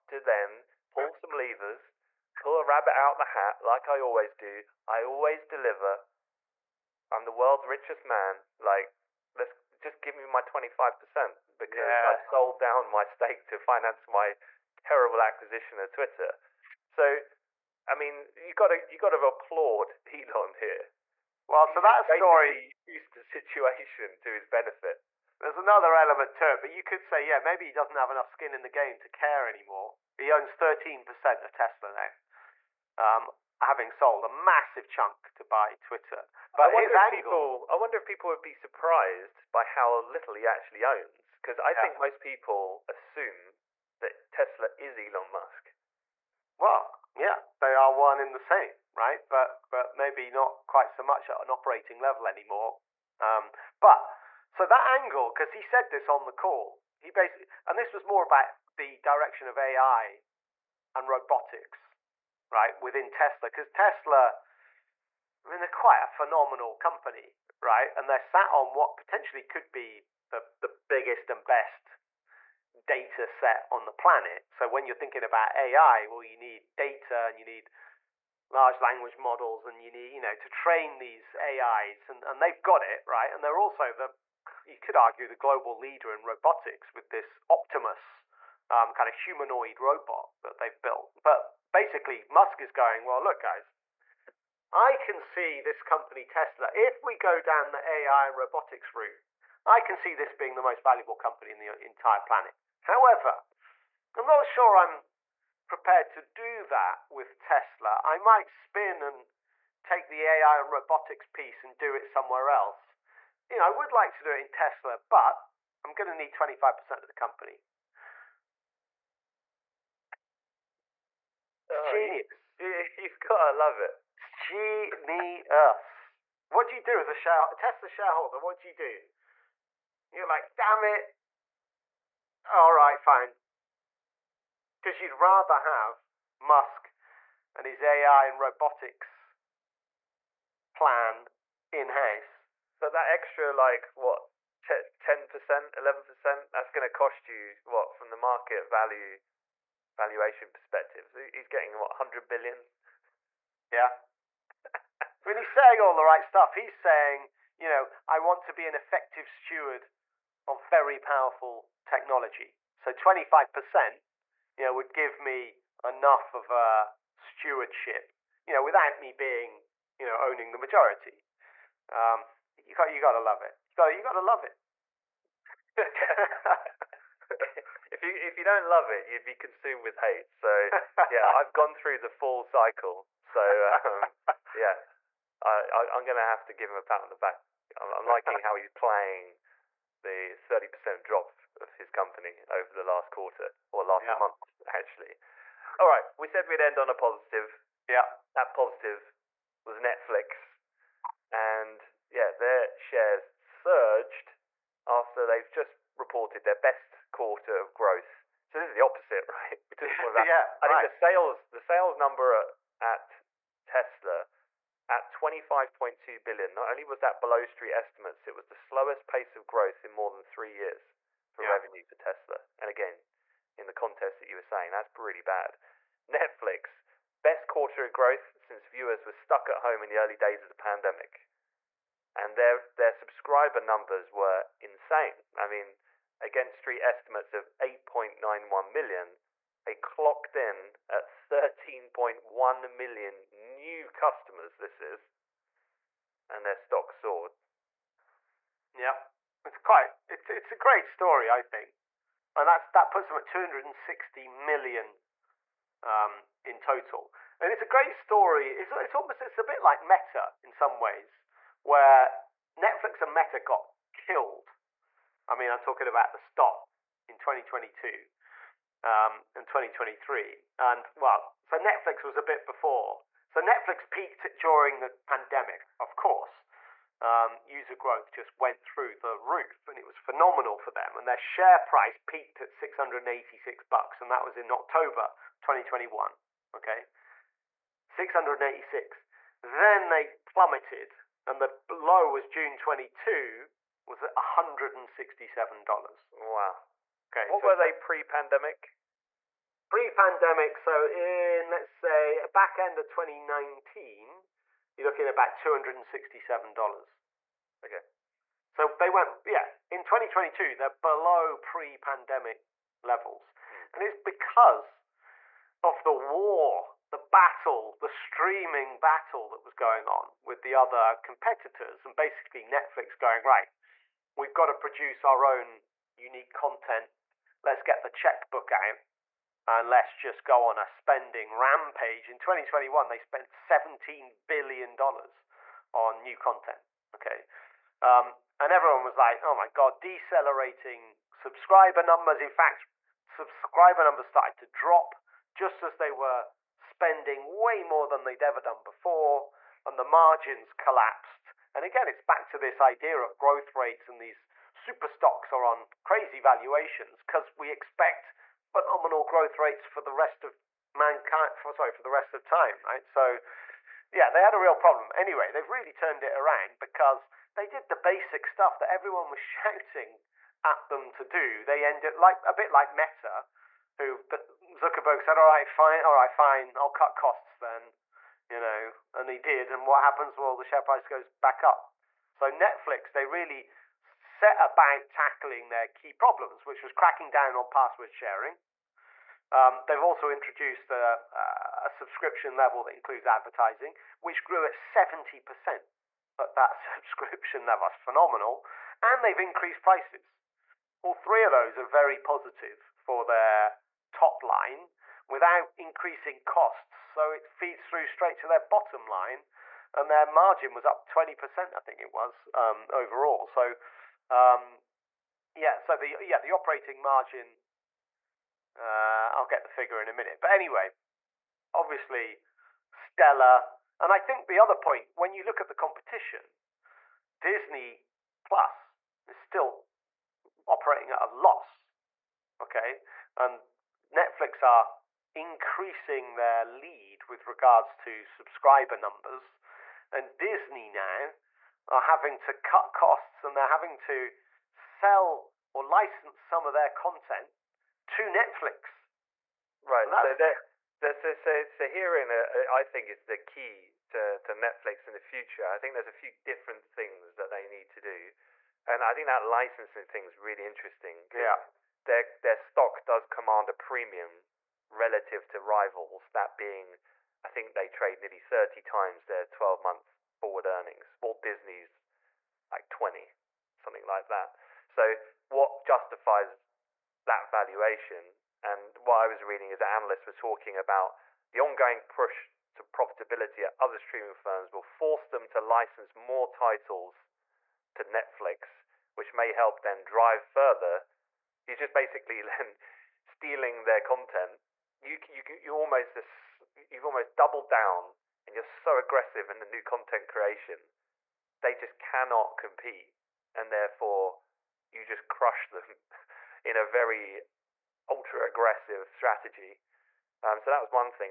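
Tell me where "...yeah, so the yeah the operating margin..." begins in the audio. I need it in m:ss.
6:55.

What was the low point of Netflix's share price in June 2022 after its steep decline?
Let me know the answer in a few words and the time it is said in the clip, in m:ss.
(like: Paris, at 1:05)
$167, at 4:54.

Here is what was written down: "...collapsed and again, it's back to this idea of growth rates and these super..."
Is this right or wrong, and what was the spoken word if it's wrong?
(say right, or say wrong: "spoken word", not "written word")
right.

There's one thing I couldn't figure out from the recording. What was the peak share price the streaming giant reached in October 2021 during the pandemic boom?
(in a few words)
$686.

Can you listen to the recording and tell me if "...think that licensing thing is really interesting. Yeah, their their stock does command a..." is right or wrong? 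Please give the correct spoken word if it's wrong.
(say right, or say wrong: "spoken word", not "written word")
right.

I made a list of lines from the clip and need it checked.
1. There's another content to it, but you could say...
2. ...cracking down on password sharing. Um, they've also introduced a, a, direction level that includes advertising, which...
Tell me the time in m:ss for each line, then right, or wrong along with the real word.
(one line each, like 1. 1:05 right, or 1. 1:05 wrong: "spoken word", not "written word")
1. 0:25 wrong: "element", not "content"
2. 6:26 wrong: "subscription", not "direction".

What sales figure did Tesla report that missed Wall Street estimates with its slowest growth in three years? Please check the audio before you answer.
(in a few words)
25.2 billion.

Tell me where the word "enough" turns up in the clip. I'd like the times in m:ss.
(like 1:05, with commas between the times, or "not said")
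0:28, 2:45.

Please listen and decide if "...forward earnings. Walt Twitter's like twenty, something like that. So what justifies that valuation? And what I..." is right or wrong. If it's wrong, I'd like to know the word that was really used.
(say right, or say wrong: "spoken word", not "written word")
wrong: "Disney", not "Twitter".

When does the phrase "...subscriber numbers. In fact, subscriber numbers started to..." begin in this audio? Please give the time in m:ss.
5:41.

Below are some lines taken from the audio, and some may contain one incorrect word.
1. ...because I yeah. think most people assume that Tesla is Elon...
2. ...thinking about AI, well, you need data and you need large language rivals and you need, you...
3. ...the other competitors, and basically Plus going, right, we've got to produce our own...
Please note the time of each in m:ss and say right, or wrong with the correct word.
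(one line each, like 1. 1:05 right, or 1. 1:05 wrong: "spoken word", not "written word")
1. 0:41 right
2. 1:14 wrong: "models", not "rivals"
3. 5:20 wrong: "Netflix", not "Plus".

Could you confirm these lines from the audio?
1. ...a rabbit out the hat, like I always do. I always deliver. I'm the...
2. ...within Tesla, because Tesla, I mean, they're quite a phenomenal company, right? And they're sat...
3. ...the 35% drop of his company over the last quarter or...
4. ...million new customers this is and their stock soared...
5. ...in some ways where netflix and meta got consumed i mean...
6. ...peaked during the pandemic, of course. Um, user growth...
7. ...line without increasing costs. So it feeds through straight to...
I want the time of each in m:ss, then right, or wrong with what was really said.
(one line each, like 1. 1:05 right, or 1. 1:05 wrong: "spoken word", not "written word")
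1. 0:02 right
2. 1:02 right
3. 3:10 wrong: "30", not "35"
4. 4:02 right
5. 4:20 wrong: "killed", not "consumed"
6. 4:33 right
7. 6:44 right.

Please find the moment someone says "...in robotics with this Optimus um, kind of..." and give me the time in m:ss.
1:26.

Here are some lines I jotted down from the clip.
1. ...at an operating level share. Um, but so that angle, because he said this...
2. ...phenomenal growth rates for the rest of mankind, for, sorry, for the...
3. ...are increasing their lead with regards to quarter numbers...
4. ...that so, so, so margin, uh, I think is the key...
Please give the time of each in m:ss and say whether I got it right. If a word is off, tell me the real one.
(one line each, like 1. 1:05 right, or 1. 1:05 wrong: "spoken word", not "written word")
1. 0:51 wrong: "anymore", not "share"
2. 5:58 right
3. 7:14 wrong: "subscriber", not "quarter"
4. 7:30 wrong: "herein", not "margin".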